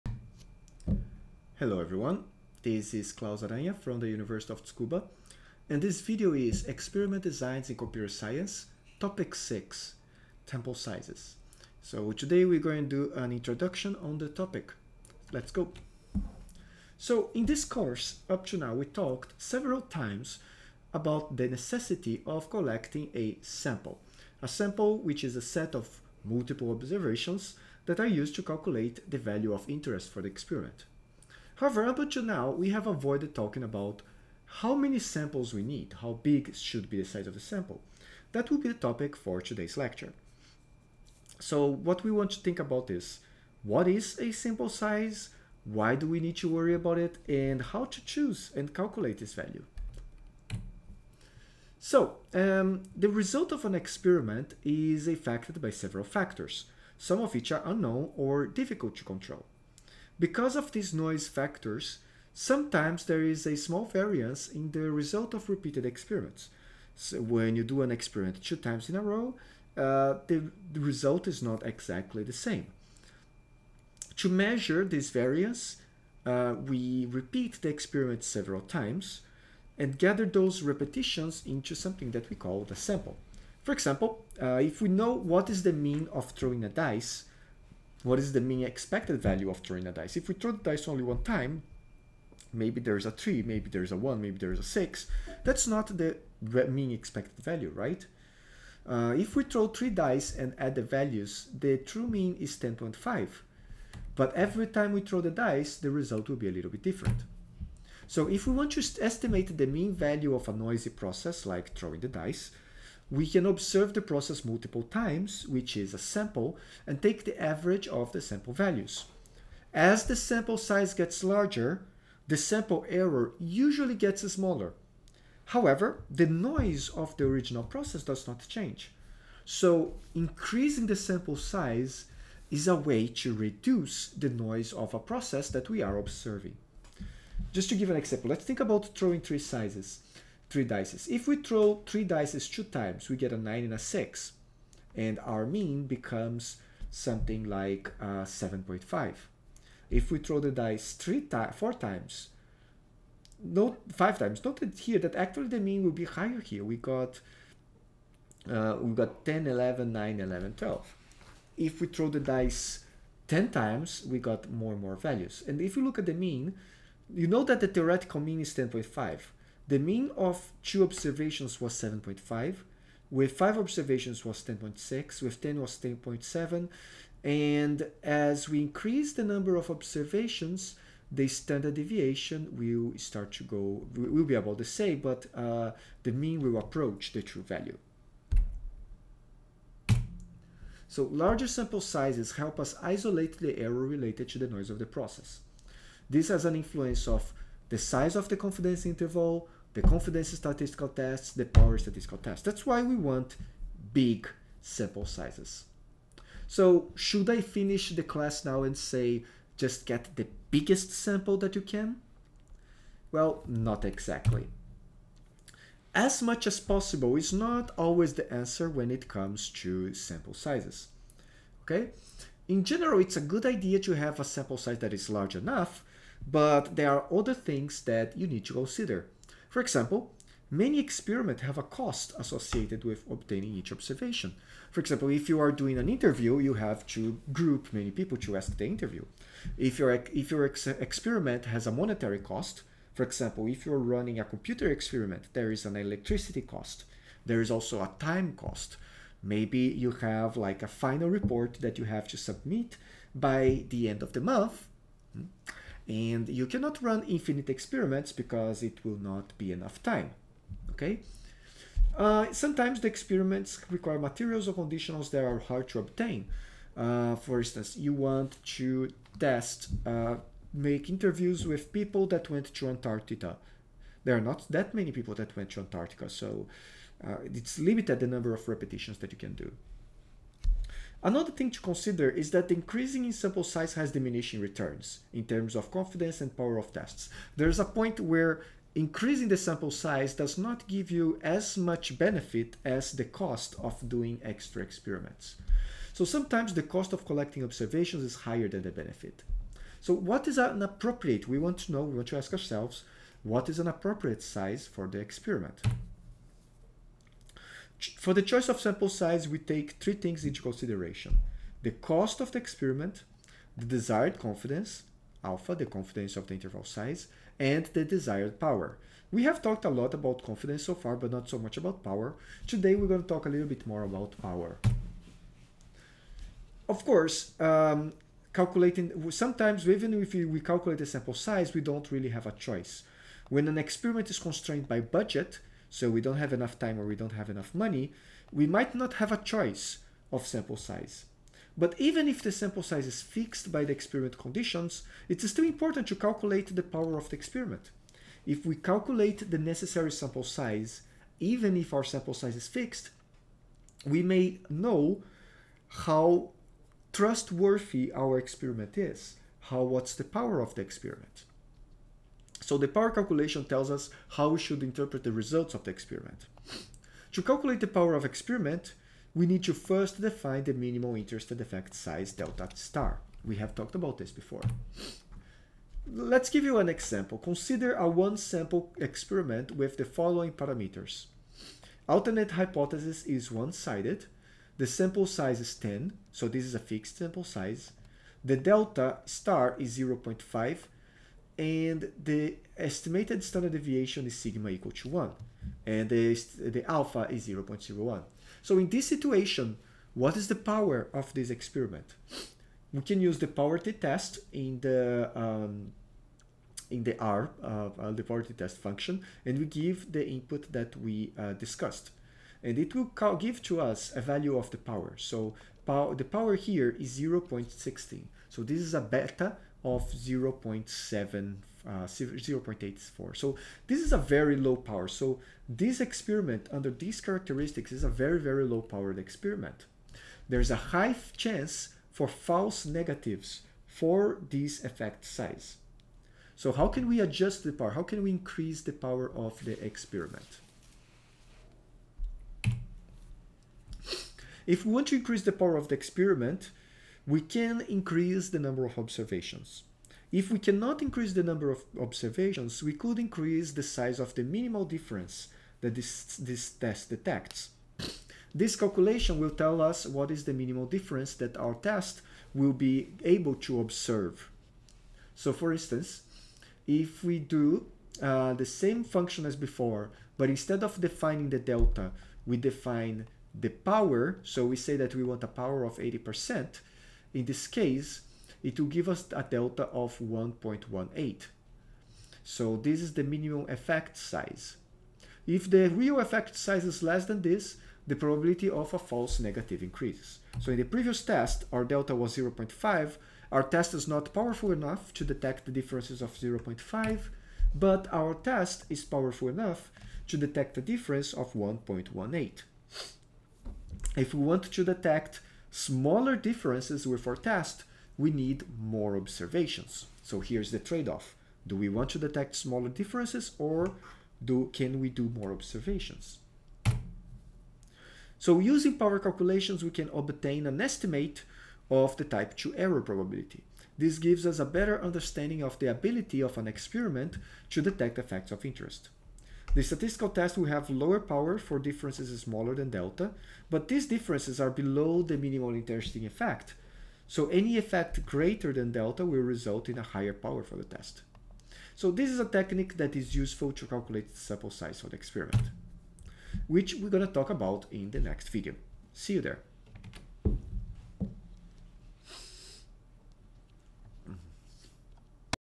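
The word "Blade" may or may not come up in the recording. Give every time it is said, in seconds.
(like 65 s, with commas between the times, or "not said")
not said.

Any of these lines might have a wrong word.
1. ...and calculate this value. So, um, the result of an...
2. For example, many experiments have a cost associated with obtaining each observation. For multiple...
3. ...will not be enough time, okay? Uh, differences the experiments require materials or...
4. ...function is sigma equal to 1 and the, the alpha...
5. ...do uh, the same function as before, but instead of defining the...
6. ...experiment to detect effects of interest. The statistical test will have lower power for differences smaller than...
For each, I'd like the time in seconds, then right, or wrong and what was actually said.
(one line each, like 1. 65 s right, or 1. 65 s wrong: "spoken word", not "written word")
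1. 48 s right
2. 229 s wrong: "example", not "multiple"
3. 258 s wrong: "sometimes", not "differences"
4. 393 s wrong: "deviation", not "function"
5. 467 s right
6. 526 s right.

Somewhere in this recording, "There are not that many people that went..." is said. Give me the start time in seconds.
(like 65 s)
274 s.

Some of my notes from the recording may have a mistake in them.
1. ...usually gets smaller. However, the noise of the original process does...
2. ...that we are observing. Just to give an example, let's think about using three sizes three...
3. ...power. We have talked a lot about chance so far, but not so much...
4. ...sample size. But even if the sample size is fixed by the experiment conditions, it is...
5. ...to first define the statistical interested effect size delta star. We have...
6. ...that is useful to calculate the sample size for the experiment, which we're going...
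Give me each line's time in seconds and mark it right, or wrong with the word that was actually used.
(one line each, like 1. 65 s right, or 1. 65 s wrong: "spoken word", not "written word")
1. 123 s right
2. 135 s wrong: "throwing", not "using"
3. 318 s wrong: "confidence", not "chance"
4. 340 s right
5. 369 s wrong: "minimal", not "statistical"
6. 542 s right.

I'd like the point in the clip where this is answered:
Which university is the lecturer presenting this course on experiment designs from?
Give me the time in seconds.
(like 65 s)
4 s.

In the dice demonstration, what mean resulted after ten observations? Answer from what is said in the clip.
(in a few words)
10.7.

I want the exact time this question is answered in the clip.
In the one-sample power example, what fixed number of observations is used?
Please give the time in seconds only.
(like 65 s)
384 s.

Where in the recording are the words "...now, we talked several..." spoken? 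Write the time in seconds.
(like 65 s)
18 s.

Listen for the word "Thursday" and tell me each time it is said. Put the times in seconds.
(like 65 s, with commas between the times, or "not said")
not said.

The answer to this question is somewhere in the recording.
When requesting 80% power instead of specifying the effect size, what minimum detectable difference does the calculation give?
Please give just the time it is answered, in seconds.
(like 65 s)
479 s.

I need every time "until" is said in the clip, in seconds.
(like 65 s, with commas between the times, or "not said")
31 s.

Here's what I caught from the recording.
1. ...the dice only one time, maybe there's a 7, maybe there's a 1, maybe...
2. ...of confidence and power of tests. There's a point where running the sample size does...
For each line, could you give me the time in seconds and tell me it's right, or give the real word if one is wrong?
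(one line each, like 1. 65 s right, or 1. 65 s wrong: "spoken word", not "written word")
1. 90 s wrong: "3", not "7"
2. 285 s wrong: "increasing", not "running".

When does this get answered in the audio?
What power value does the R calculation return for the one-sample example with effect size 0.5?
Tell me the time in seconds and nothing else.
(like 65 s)
416 s.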